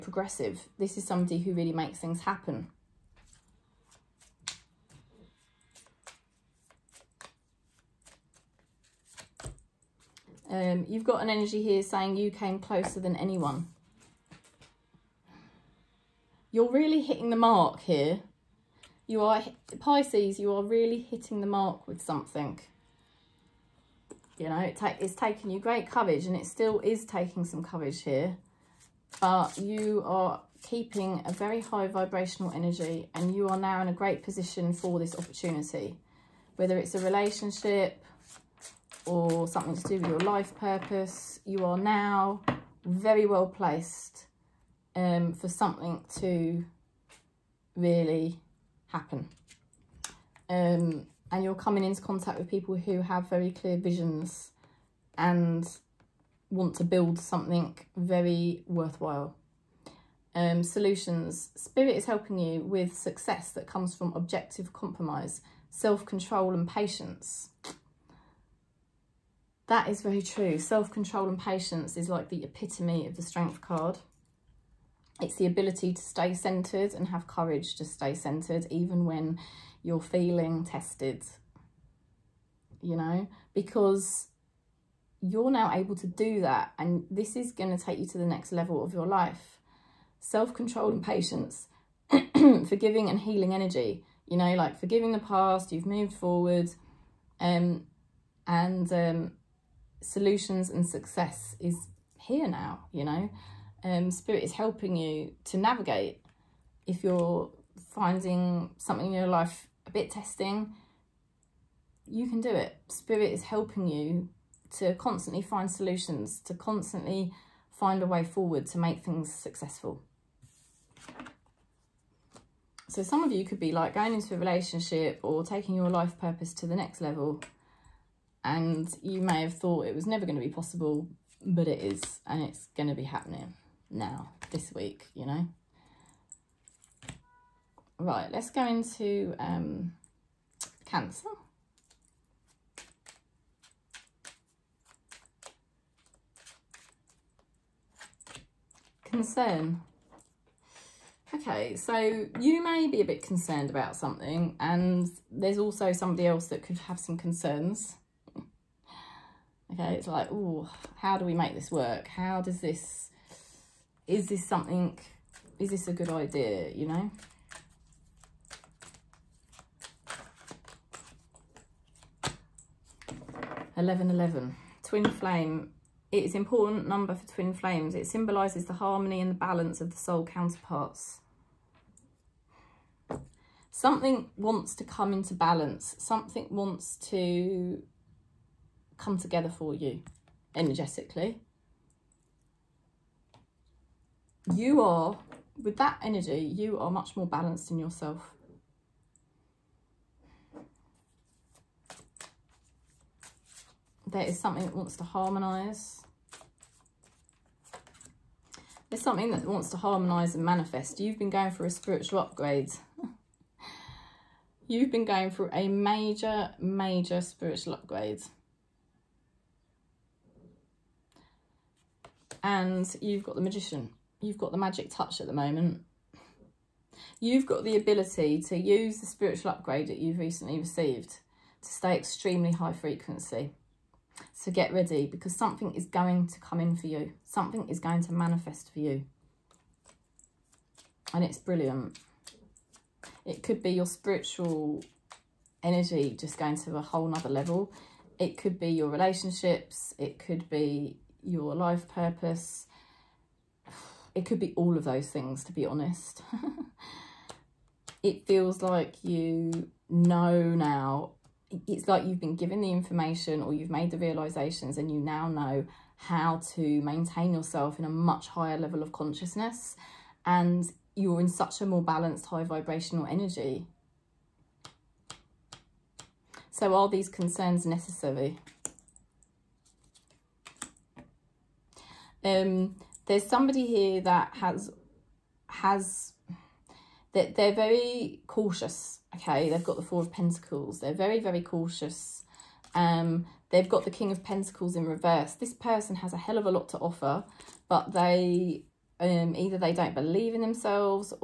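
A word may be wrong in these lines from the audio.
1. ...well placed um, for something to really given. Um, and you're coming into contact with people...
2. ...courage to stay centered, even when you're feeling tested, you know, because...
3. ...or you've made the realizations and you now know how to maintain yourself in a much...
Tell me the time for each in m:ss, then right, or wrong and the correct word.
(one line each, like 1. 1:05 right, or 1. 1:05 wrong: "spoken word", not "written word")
1. 0:43 wrong: "happen", not "given"
2. 1:17 right
3. 4:23 right.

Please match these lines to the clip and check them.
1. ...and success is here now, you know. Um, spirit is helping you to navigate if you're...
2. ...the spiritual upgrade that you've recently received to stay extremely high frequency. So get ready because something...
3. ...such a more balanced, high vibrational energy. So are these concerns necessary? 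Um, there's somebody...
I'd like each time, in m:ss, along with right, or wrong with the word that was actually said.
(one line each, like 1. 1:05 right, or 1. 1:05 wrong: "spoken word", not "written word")
1. 1:40 right
2. 3:48 right
3. 4:31 right.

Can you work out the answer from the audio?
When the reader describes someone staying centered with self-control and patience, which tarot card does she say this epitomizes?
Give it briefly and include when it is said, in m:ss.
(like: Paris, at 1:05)
Strength, at 1:13.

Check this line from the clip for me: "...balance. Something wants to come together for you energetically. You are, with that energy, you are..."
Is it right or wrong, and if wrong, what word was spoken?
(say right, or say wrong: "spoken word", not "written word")
right.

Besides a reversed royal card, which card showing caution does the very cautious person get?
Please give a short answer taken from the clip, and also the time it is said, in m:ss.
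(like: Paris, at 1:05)
Four of Pentacles, at 4:49.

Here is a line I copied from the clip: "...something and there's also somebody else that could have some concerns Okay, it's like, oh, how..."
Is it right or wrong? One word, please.
right.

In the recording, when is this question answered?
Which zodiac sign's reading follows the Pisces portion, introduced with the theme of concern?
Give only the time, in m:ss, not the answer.
2:20.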